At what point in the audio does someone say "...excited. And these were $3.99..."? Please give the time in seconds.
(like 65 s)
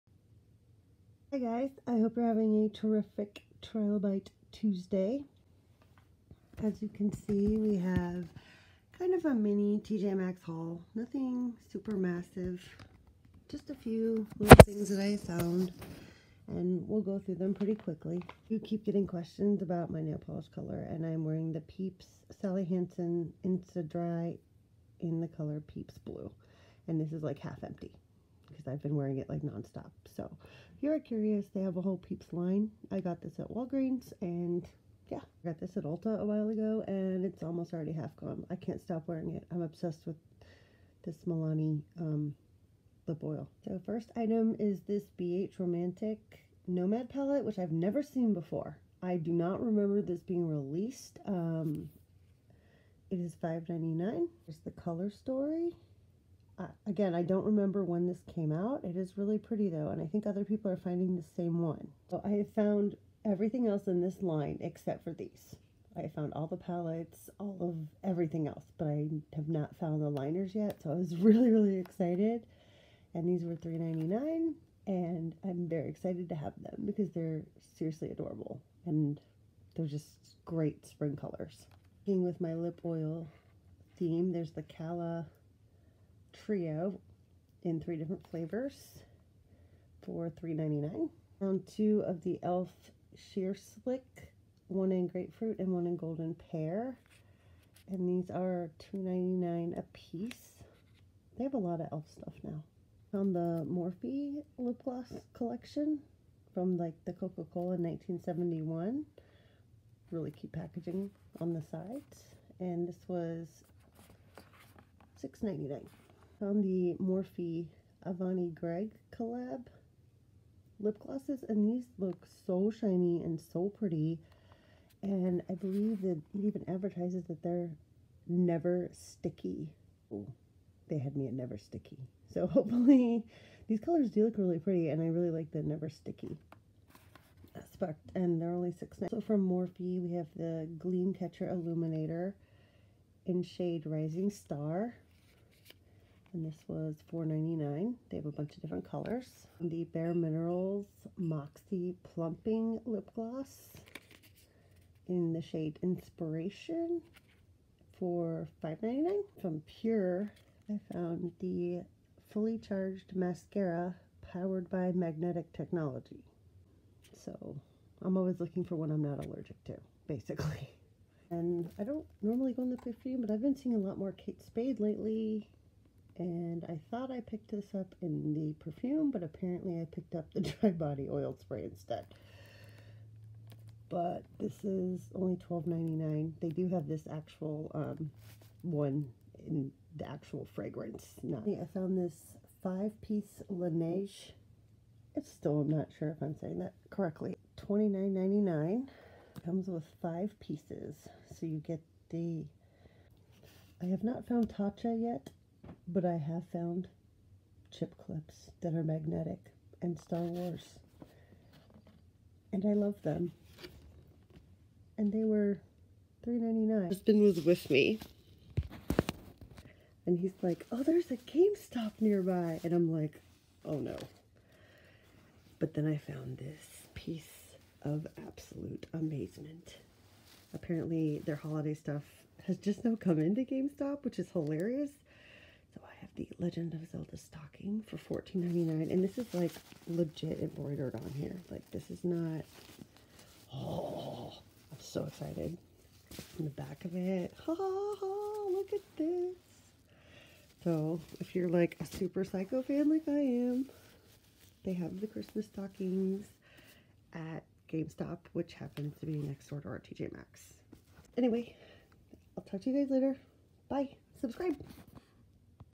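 71 s.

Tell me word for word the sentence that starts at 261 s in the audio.
Anyway, I'll talk to you guys later.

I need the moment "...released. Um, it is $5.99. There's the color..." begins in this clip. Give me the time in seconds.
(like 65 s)
50 s.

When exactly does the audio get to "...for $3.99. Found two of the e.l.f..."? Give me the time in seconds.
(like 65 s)
90 s.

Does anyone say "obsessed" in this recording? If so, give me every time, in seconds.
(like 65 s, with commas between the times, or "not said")
39 s.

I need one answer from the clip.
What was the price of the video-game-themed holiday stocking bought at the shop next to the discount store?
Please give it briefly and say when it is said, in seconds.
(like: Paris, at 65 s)
$14.99, at 238 s.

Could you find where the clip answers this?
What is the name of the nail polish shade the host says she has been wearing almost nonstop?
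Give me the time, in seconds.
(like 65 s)
25 s.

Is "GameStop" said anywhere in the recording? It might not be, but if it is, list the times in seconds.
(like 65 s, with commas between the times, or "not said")
221 s, 233 s, 257 s.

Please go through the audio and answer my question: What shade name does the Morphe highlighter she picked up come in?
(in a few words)
Rising Star.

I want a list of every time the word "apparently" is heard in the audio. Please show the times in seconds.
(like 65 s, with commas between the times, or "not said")
179 s, 230 s.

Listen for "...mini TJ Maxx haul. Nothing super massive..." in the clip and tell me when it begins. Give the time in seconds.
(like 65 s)
9 s.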